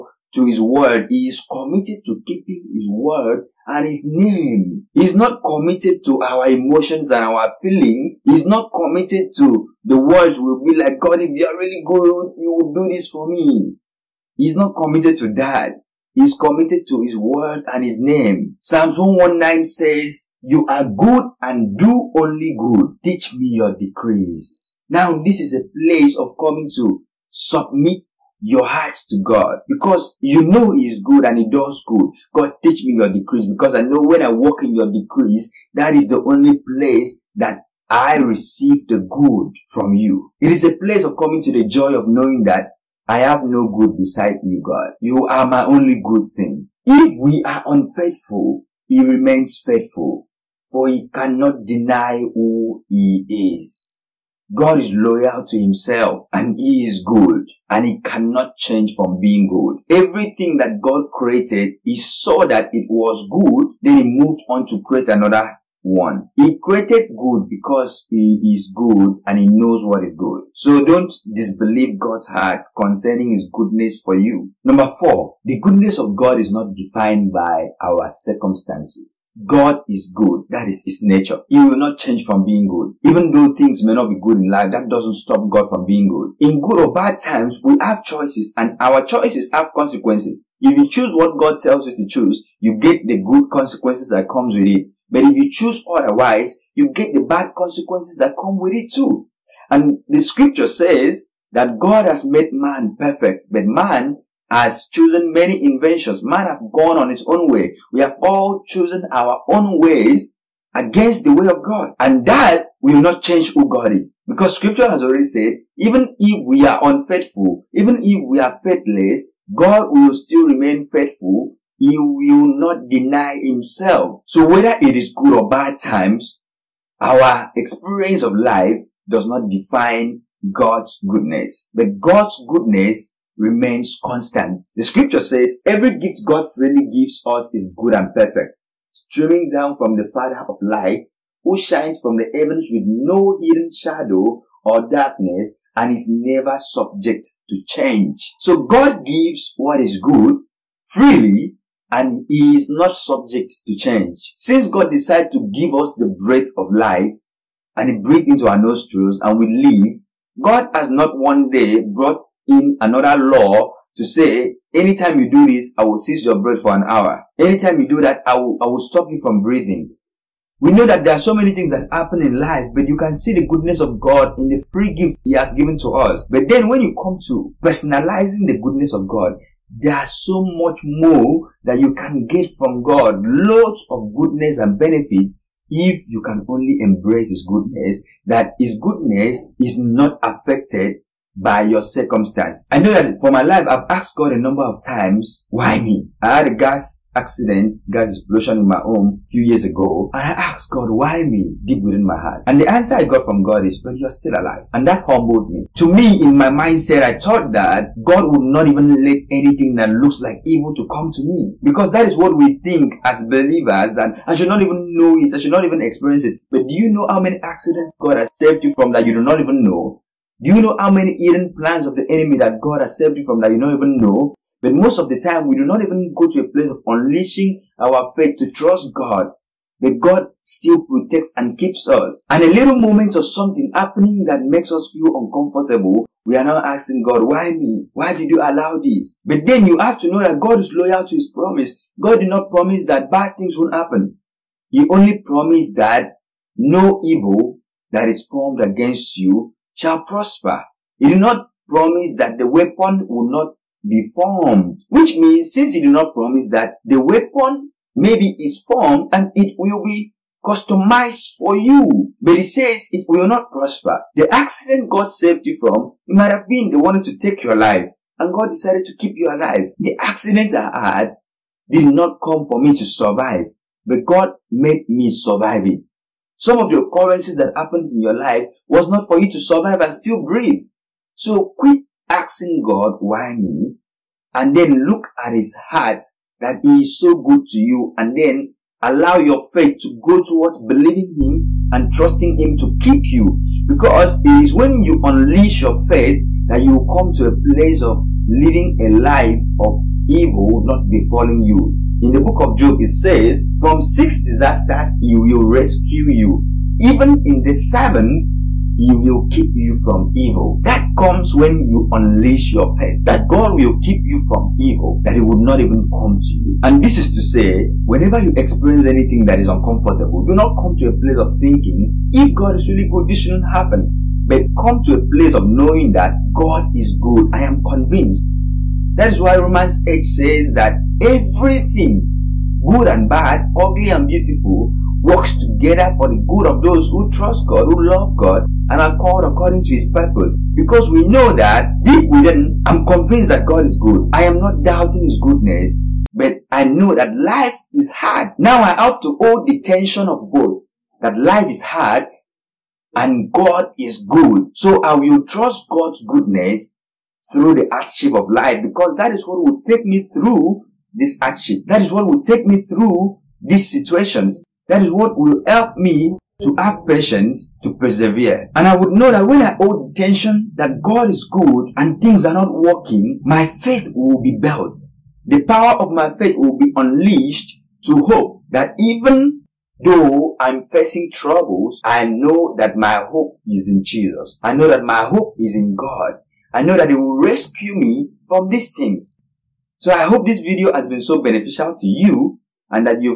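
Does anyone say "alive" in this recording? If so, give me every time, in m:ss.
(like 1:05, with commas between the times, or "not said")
3:24, 4:29.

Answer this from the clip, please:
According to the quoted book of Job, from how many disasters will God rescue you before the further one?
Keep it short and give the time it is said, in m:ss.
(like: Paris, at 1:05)
6, at 5:03.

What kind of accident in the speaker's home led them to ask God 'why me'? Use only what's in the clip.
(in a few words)
Gas explosion.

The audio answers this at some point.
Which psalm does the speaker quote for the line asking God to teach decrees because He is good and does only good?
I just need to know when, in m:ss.
0:18.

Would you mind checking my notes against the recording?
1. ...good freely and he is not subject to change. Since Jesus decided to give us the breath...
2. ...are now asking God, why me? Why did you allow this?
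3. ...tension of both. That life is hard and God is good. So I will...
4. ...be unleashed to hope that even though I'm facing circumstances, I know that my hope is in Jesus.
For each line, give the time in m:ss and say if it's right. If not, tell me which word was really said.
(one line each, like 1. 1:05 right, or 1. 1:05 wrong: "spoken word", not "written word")
1. 2:29 wrong: "God", not "Jesus"
2. 3:56 right
3. 5:49 right
4. 6:16 wrong: "troubles", not "circumstances".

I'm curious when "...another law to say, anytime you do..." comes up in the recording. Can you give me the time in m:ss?
2:42.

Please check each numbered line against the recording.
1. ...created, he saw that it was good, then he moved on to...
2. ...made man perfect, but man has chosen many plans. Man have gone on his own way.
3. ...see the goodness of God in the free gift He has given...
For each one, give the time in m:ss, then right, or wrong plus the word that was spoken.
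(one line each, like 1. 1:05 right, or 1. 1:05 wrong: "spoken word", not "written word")
1. 1:01 right
2. 1:42 wrong: "inventions", not "plans"
3. 2:53 right.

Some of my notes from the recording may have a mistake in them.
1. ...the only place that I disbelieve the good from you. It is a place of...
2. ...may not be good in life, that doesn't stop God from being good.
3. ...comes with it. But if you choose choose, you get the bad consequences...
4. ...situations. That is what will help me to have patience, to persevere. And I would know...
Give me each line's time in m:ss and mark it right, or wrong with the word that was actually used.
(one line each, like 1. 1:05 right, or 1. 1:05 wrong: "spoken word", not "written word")
1. 0:36 wrong: "receive", not "disbelieve"
2. 1:23 right
3. 1:34 wrong: "otherwise", not "choose"
4. 6:03 right.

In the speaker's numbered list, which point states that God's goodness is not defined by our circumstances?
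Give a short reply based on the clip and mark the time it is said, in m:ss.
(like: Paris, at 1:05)
4, at 1:14.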